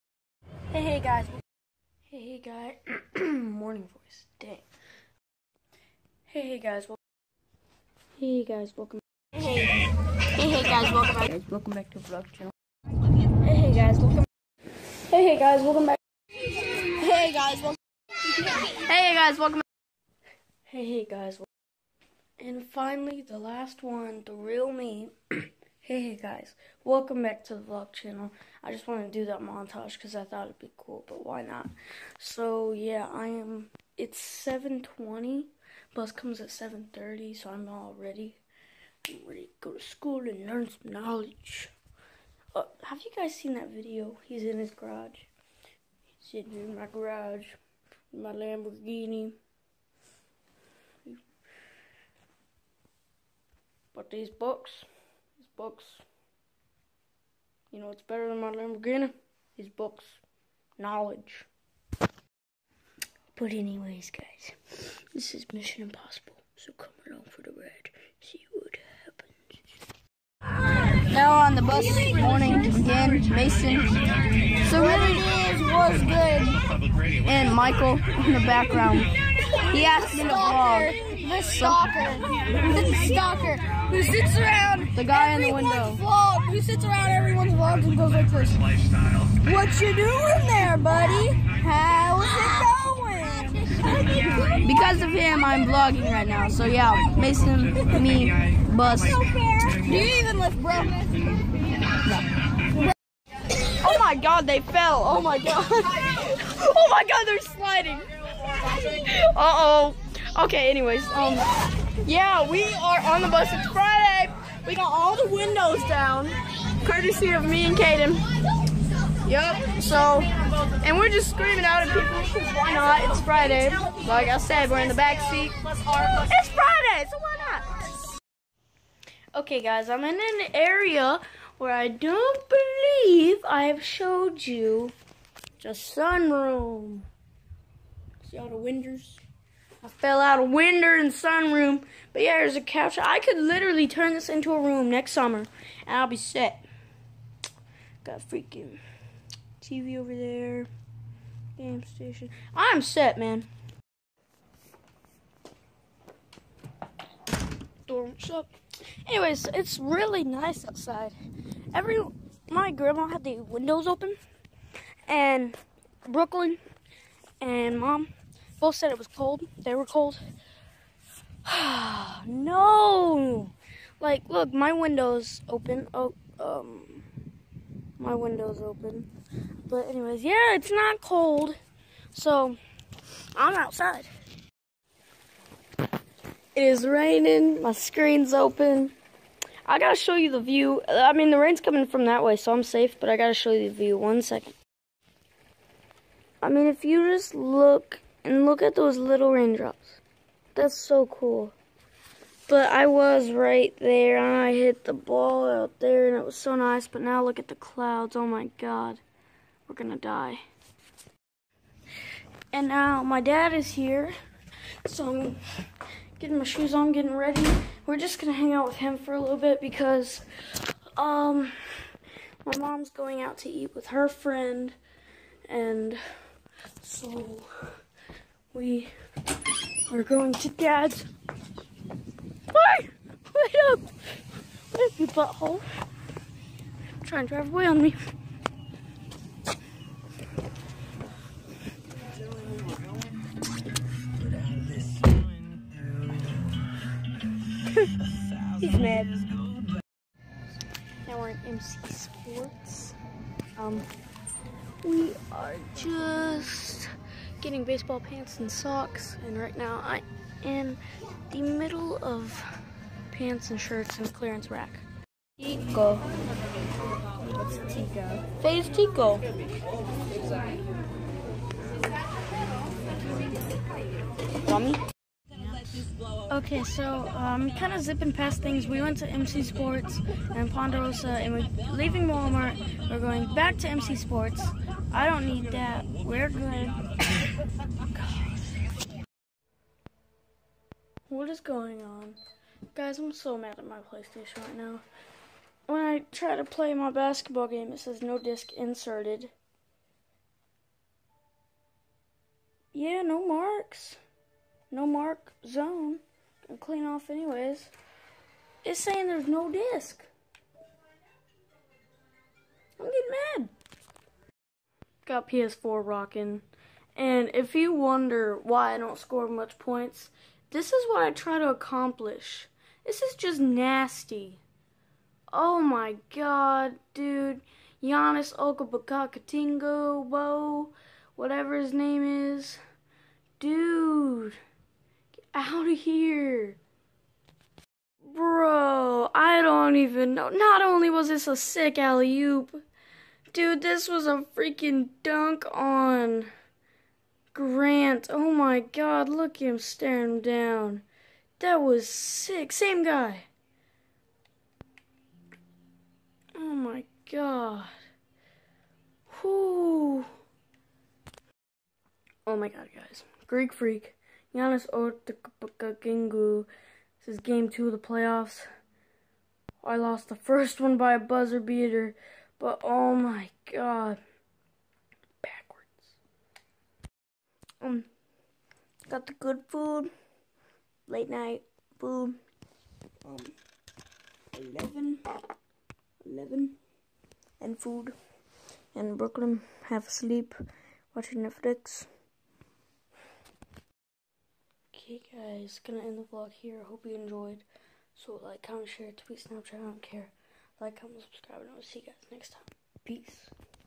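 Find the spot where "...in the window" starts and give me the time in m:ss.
1:25.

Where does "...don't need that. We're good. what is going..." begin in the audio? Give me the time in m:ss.
4:45.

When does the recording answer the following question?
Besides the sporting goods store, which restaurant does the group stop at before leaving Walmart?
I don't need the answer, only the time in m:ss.
4:40.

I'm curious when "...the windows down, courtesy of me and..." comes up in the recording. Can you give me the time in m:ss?
1:55.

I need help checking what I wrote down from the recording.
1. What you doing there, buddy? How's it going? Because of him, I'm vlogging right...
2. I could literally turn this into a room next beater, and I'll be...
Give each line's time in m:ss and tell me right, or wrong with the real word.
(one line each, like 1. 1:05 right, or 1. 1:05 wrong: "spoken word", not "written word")
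1. 1:29 right
2. 2:23 wrong: "summer", not "beater".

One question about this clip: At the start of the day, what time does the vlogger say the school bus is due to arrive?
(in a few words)
7:30.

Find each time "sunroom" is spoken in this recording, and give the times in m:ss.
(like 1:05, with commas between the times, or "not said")
2:15, 2:21.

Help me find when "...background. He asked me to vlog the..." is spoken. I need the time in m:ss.
1:18.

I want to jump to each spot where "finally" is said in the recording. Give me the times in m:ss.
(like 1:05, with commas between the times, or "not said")
0:22.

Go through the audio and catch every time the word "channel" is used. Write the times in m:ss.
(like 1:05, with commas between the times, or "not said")
0:12, 0:27.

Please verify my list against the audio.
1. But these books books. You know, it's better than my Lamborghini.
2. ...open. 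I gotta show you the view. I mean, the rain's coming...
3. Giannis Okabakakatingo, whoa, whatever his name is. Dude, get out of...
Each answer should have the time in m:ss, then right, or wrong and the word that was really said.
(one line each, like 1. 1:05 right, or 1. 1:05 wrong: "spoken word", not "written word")
1. 0:53 right
2. 3:08 right
3. 5:27 right.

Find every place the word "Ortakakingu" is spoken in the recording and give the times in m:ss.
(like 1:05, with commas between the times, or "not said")
6:04.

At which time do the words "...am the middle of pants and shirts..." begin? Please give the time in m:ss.
4:20.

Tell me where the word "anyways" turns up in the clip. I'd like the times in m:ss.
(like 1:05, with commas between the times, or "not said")
1:03, 1:50, 2:39, 2:59, 5:07.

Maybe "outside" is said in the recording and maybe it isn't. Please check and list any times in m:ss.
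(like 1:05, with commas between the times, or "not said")
2:40, 3:03.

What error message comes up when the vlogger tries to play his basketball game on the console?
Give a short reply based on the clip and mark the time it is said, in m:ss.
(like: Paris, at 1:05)
No disc inserted, at 4:58.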